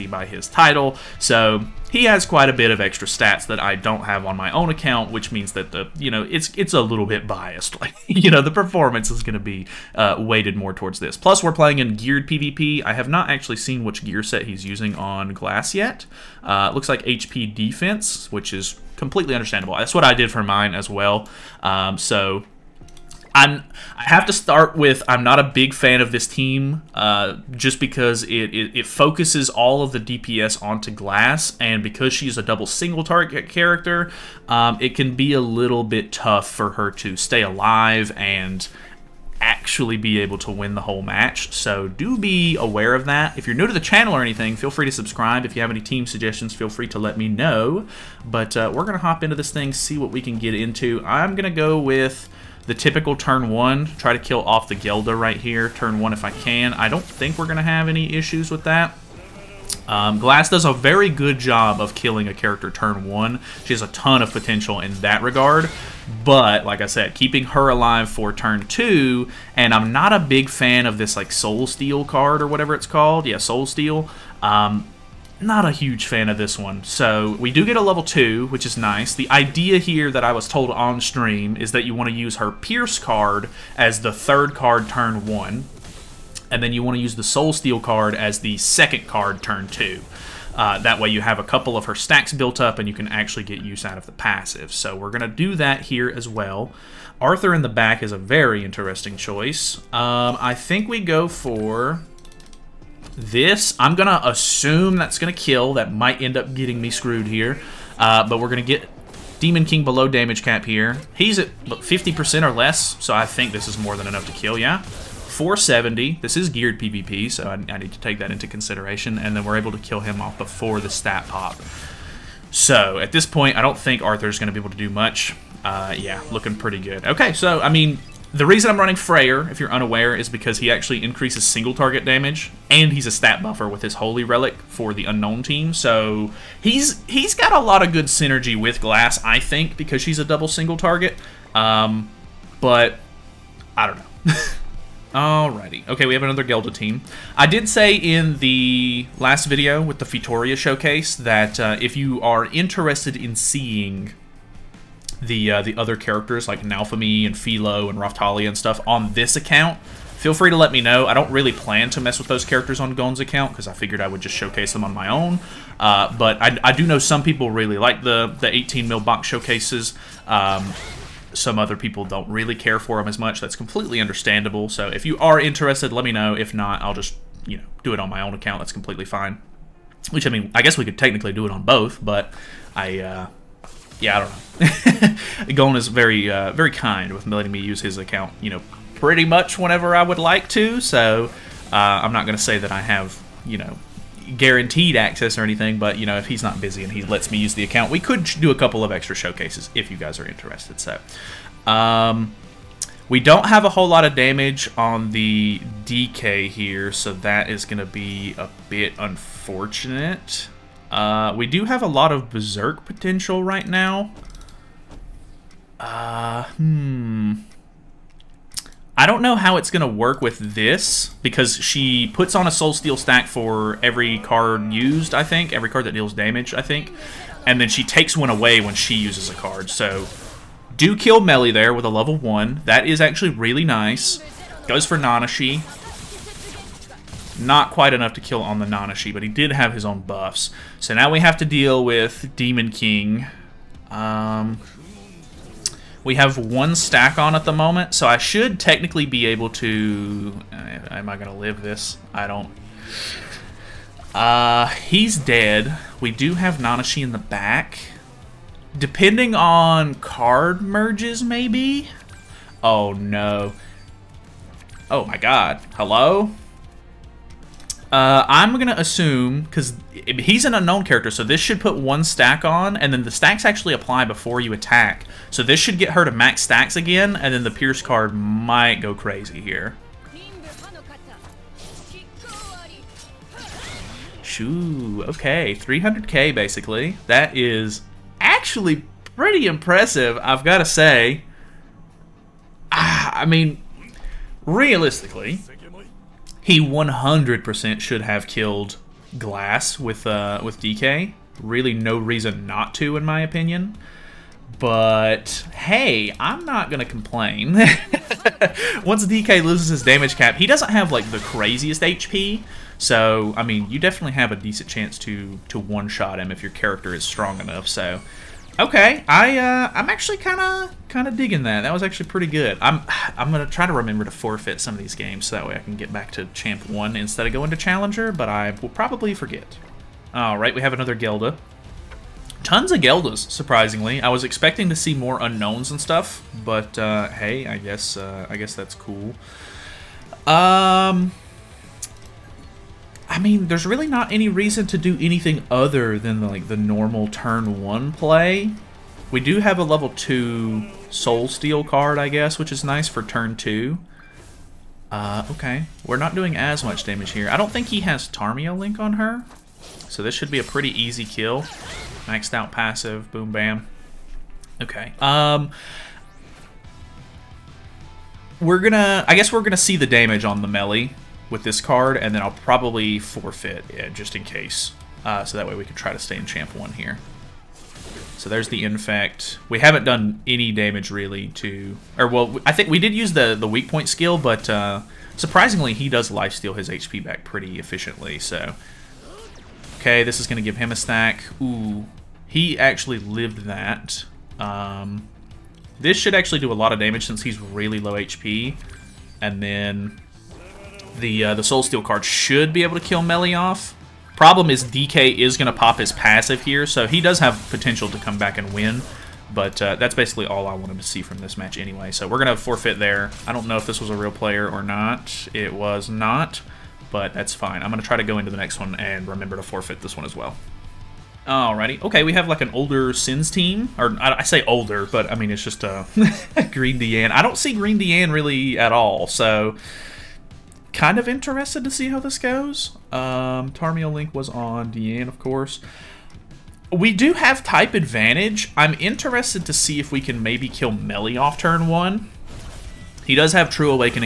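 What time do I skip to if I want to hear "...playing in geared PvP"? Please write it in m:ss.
0:11.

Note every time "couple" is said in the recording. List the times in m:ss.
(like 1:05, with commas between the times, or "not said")
1:31, 3:18.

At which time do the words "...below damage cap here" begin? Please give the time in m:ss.
1:49.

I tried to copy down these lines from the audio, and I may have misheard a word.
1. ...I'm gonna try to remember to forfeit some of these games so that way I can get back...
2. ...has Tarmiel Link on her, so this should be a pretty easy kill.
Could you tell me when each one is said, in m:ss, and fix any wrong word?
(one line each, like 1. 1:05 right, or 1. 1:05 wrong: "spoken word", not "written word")
1. 5:23 right
2. 5:57 right.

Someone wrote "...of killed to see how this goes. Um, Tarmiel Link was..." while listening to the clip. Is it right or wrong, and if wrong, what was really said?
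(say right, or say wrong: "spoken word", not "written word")
wrong: "interested", not "killed".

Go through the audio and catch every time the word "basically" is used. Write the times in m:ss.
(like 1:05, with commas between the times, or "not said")
4:46, 6:49.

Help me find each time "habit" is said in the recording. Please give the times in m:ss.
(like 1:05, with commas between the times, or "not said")
not said.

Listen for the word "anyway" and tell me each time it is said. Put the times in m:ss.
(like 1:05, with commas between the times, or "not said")
6:51.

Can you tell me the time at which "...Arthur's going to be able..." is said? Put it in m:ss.
2:04.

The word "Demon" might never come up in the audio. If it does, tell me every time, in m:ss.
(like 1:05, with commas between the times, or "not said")
1:49, 4:02.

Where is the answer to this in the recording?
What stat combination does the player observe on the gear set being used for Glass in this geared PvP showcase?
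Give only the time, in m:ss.
0:17.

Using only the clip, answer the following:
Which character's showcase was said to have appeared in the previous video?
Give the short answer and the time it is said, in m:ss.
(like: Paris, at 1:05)
Fitoria, at 2:30.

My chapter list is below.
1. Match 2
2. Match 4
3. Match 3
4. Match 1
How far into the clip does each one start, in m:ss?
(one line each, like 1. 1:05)
1. 2:24
2. 7:00
3. 5:29
4. 0:36.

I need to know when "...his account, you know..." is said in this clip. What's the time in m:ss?
3:07.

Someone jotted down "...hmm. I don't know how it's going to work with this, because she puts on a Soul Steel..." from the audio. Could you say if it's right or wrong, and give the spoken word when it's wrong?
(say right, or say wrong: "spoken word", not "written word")
right.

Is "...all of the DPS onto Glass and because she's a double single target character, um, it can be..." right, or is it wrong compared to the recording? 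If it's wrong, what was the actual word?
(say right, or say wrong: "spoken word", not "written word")
right.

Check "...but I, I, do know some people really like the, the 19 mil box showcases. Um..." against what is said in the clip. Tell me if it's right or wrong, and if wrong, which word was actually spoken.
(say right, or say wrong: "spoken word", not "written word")
wrong: "18", not "19".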